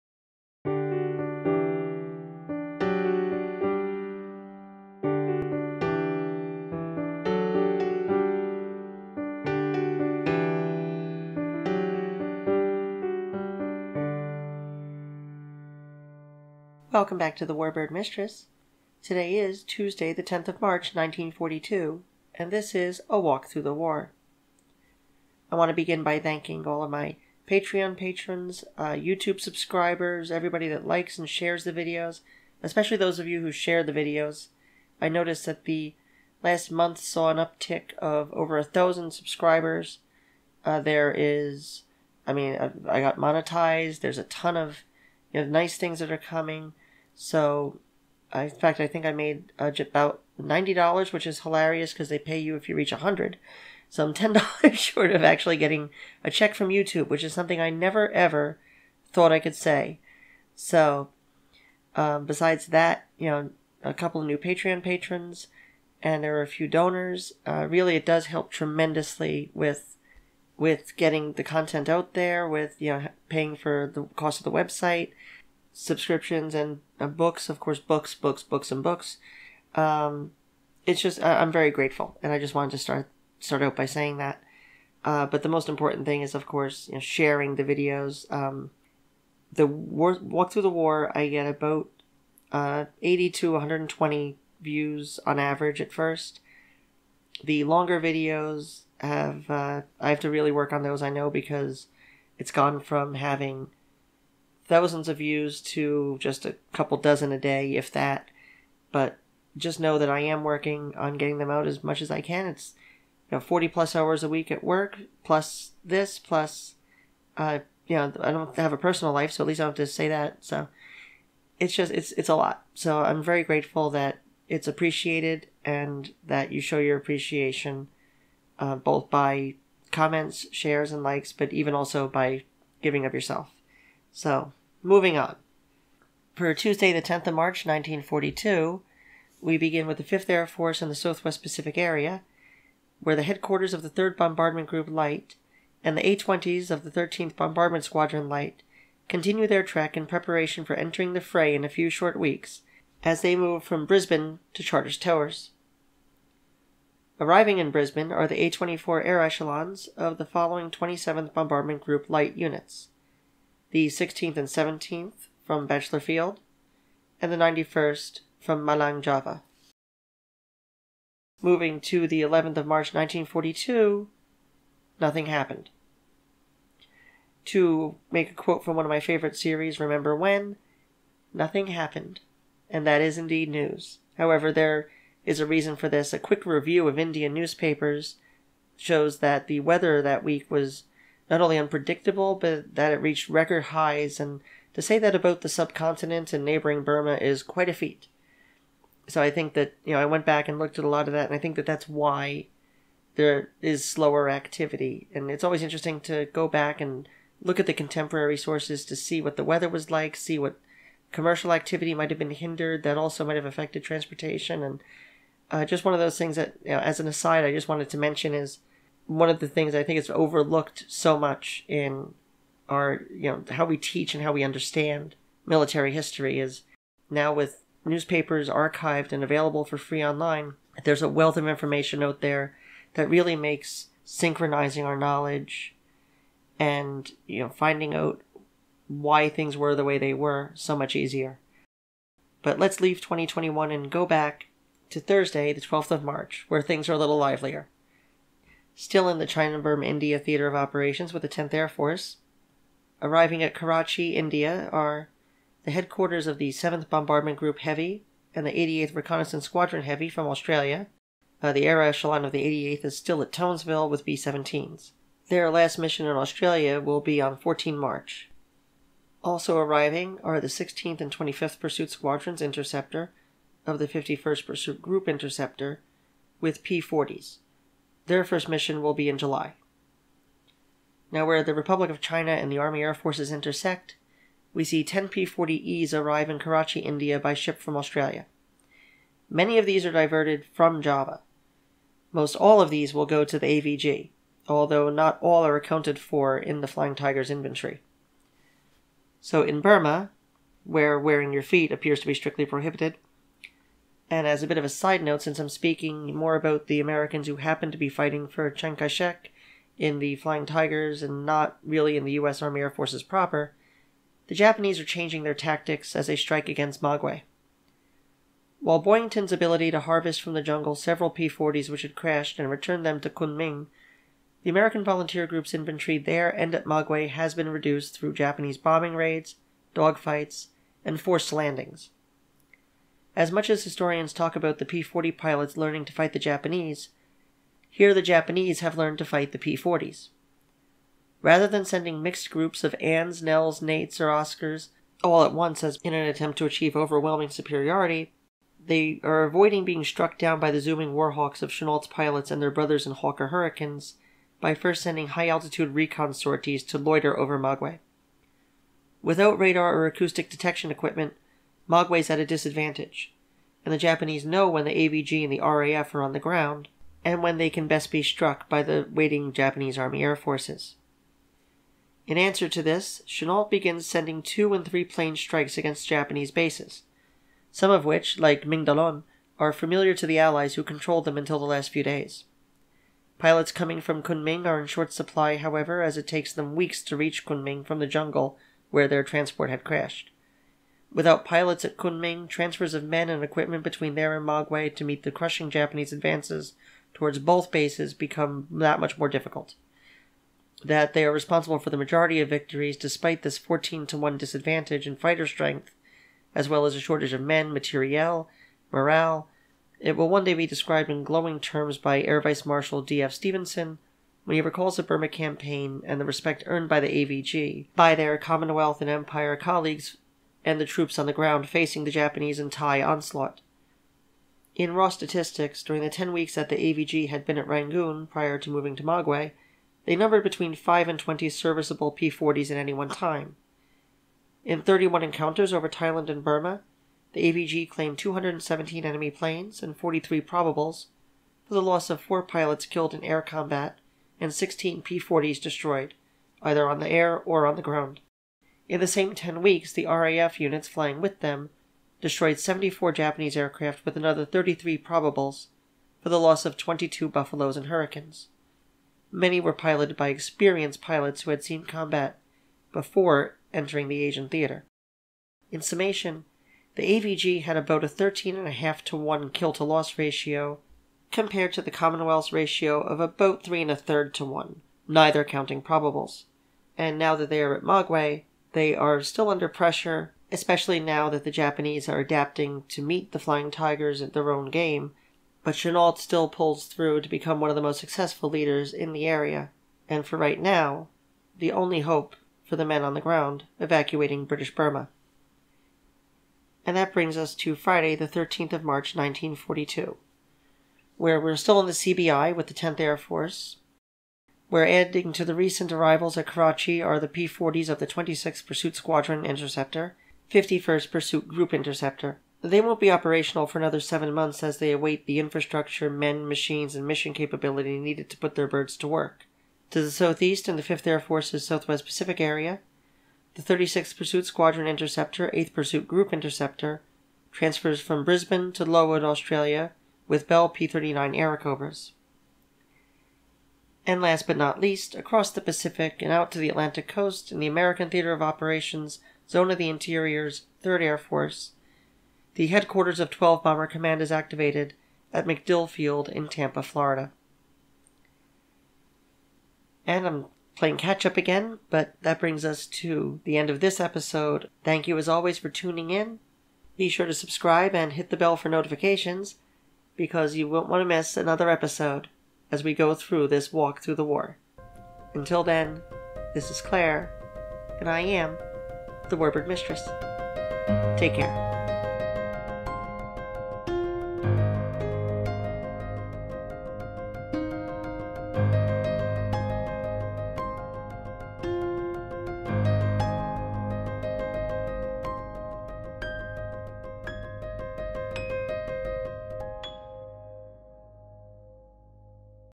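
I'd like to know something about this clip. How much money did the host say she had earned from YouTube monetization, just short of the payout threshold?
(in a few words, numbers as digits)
$90.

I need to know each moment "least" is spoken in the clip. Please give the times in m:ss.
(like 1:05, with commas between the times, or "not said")
1:59, 8:54.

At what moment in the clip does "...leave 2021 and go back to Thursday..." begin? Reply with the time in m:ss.
4:02.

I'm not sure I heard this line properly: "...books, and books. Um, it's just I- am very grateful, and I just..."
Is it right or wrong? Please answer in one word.
right.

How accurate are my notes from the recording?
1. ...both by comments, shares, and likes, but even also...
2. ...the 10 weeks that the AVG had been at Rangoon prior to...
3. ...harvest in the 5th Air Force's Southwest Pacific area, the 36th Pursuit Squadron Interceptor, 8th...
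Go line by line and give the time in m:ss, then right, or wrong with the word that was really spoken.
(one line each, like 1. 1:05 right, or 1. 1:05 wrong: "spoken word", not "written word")
1. 2:08 right
2. 7:05 right
3. 8:39 wrong: "southeast", not "harvest".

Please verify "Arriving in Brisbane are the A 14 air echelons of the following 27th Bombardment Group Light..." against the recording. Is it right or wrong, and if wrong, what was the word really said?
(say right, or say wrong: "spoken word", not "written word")
wrong: "24", not "14".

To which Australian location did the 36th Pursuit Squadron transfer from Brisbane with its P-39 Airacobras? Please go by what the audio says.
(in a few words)
Lowood.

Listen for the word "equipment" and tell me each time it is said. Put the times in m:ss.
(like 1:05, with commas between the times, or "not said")
6:00, 6:33.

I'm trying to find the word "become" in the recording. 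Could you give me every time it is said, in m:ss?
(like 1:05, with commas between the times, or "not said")
6:37, 8:07.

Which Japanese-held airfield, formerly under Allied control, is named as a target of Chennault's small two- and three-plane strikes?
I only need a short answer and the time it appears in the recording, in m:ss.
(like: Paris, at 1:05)
Mingaladon, at 6:18.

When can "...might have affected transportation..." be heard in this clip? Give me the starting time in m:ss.
3:33.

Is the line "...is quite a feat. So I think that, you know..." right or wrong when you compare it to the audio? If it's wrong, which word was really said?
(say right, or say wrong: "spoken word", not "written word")
right.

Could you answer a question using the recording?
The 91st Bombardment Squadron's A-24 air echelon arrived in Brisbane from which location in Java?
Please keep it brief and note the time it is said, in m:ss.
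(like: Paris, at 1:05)
Malang, at 2:48.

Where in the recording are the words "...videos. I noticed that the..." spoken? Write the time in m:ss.
0:33.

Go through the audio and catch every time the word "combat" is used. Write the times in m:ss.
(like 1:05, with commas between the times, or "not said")
7:23, 7:41.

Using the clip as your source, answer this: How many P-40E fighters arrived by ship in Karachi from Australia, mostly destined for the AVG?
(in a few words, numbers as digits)
10.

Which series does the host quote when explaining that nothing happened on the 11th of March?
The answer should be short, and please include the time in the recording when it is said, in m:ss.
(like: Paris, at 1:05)
Remember When, at 2:59.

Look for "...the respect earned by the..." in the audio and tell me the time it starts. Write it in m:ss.
6:56.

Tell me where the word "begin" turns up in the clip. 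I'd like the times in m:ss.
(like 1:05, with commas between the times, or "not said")
0:25, 2:19, 6:13.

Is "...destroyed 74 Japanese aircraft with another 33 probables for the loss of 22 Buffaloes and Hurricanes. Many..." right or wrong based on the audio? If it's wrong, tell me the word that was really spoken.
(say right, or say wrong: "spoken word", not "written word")
right.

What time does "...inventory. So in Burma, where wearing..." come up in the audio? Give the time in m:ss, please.
4:57.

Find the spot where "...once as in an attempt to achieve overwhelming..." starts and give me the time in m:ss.
5:45.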